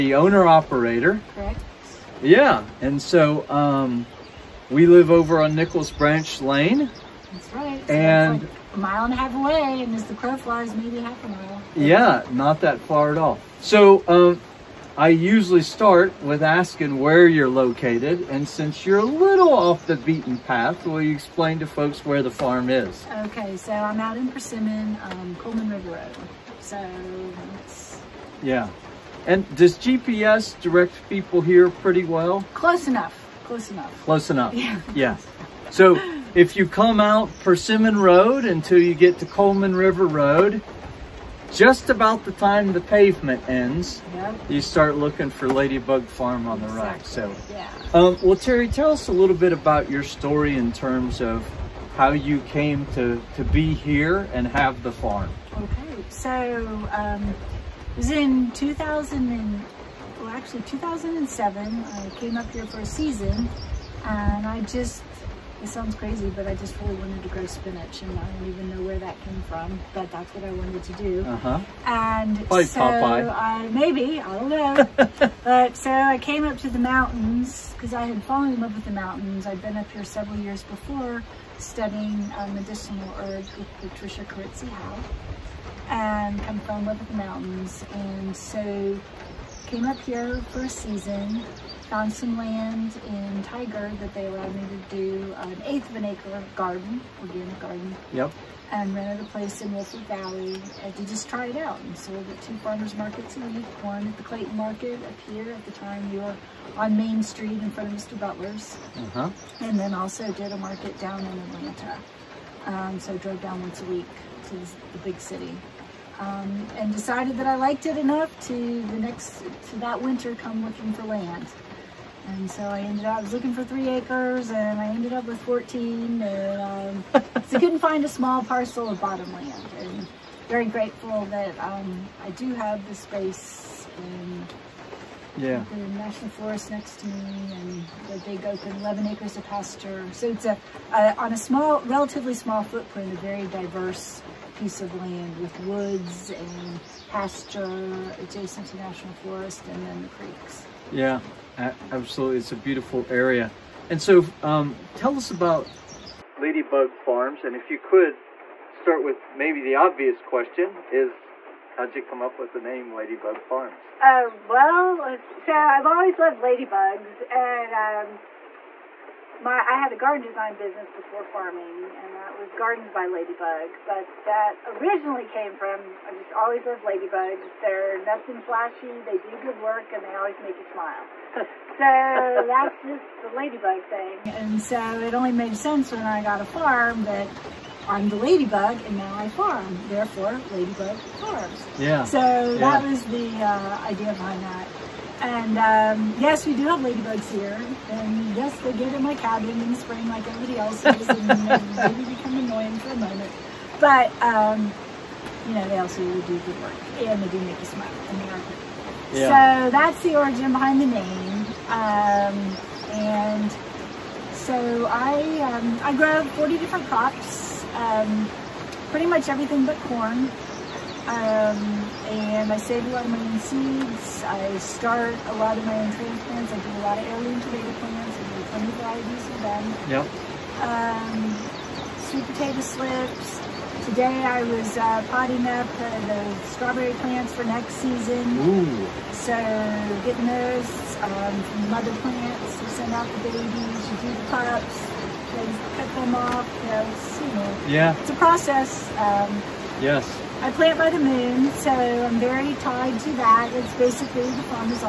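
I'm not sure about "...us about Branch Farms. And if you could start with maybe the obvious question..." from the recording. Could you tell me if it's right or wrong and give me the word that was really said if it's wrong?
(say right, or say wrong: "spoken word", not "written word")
wrong: "Ladybug", not "Branch".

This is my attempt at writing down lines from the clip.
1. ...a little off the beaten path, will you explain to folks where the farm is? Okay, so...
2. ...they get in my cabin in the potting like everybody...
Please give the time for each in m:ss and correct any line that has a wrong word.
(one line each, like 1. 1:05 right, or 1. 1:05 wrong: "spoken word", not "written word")
1. 0:18 right
2. 3:18 wrong: "spring", not "potting".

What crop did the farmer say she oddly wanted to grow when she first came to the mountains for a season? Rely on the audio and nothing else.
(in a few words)
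spinach.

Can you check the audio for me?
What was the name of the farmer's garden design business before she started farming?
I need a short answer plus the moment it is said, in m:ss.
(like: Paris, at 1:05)
Gardens by Ladybug, at 2:52.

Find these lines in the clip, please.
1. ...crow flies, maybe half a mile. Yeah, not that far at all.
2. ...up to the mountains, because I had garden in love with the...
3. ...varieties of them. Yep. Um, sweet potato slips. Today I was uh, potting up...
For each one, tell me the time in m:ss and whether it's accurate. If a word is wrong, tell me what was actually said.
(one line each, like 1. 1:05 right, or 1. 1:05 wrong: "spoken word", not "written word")
1. 0:10 right
2. 1:16 wrong: "fallen", not "garden"
3. 3:48 right.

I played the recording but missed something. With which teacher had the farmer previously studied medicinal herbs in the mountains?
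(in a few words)
Patricia Kyritsi Howell.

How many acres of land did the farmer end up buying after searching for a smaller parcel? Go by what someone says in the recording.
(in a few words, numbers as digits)
14.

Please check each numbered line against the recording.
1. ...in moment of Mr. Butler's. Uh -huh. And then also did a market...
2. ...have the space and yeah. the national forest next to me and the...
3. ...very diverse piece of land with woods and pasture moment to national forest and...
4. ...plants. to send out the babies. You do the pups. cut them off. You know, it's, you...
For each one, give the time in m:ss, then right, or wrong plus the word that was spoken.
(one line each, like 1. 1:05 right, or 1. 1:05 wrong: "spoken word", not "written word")
1. 1:47 wrong: "front", not "moment"
2. 2:12 right
3. 2:23 wrong: "adjacent", not "moment"
4. 4:02 right.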